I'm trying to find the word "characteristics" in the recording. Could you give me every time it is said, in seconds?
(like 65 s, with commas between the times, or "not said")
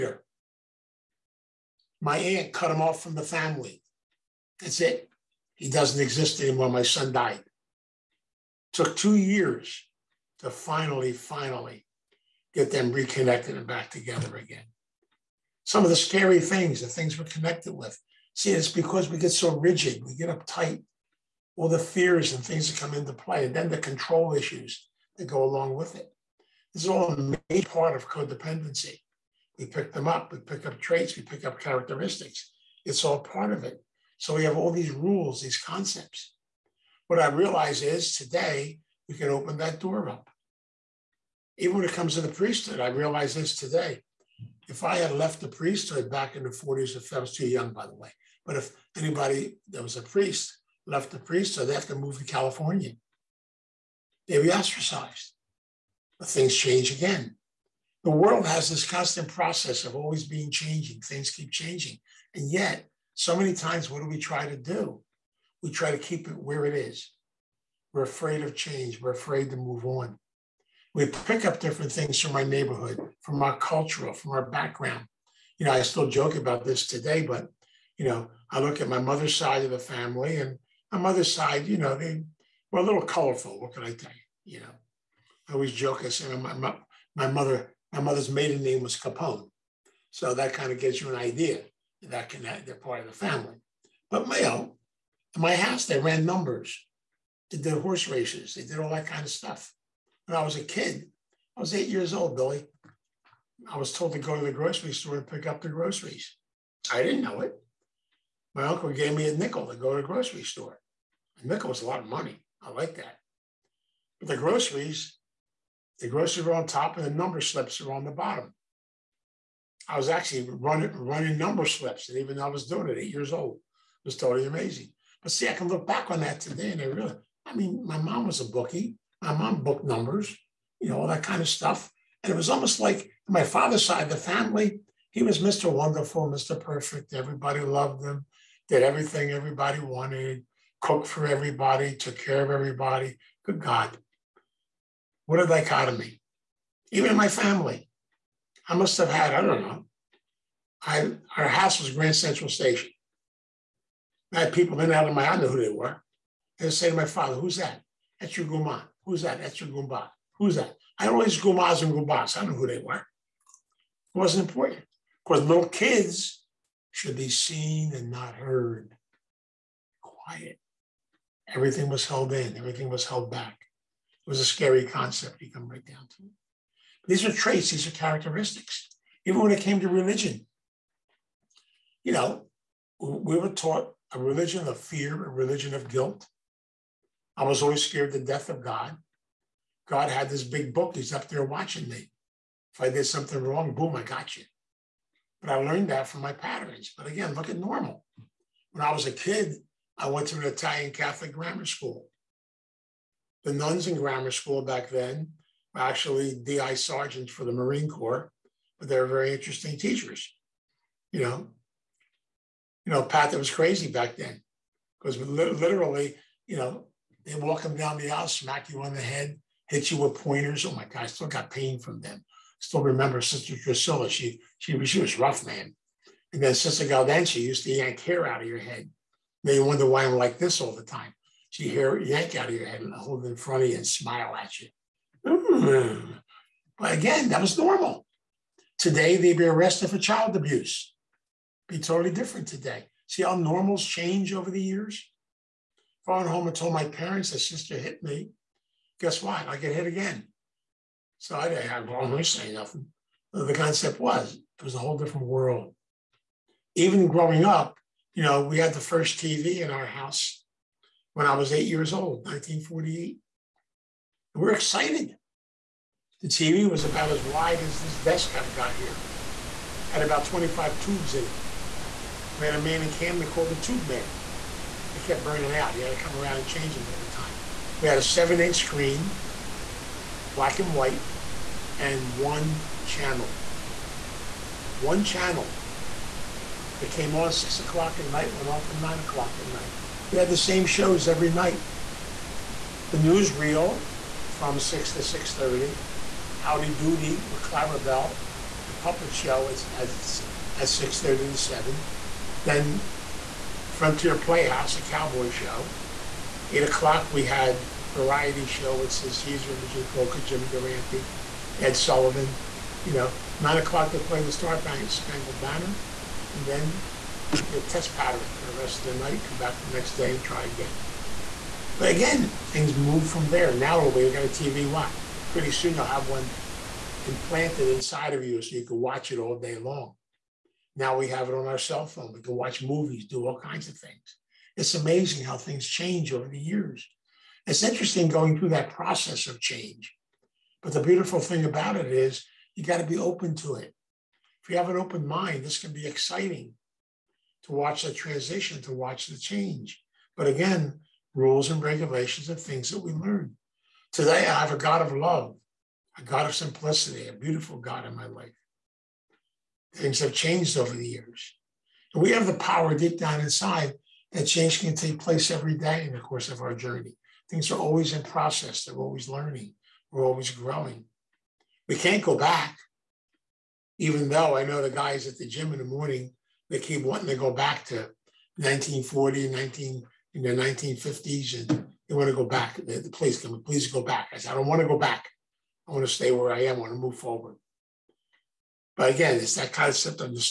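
31 s, 177 s.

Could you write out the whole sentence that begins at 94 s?
But Mayo, in my house, they ran numbers, did the horse races, they did all that kind of stuff.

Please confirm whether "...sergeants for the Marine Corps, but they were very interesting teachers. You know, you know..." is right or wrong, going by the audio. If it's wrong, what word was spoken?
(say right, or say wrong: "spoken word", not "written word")
right.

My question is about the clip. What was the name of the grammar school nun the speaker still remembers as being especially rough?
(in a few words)
Sister Drusilla.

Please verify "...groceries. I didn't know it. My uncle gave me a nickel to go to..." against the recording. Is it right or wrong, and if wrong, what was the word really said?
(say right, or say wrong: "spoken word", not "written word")
right.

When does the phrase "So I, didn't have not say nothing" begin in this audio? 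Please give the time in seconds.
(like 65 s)
251 s.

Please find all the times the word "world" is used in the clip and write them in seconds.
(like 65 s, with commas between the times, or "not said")
58 s, 255 s.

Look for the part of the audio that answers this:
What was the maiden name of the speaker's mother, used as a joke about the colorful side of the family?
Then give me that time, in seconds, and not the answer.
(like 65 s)
88 s.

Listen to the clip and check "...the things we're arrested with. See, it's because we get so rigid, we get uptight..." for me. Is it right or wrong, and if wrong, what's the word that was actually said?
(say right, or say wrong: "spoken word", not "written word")
wrong: "connected", not "arrested".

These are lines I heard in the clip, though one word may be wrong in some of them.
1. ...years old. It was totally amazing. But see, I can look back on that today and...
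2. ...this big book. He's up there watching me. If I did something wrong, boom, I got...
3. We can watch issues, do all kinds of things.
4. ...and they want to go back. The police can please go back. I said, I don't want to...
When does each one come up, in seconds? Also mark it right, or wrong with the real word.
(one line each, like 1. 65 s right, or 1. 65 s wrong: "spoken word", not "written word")
1. 123 s right
2. 190 s right
3. 332 s wrong: "movies", not "issues"
4. 381 s right.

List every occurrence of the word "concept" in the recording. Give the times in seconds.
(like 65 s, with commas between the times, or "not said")
35 s, 174 s, 253 s, 389 s.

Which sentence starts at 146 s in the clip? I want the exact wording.
Even in my family, I must have had, I don't know, I, our house was Grand Central Station.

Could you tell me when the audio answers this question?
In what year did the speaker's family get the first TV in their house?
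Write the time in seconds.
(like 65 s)
262 s.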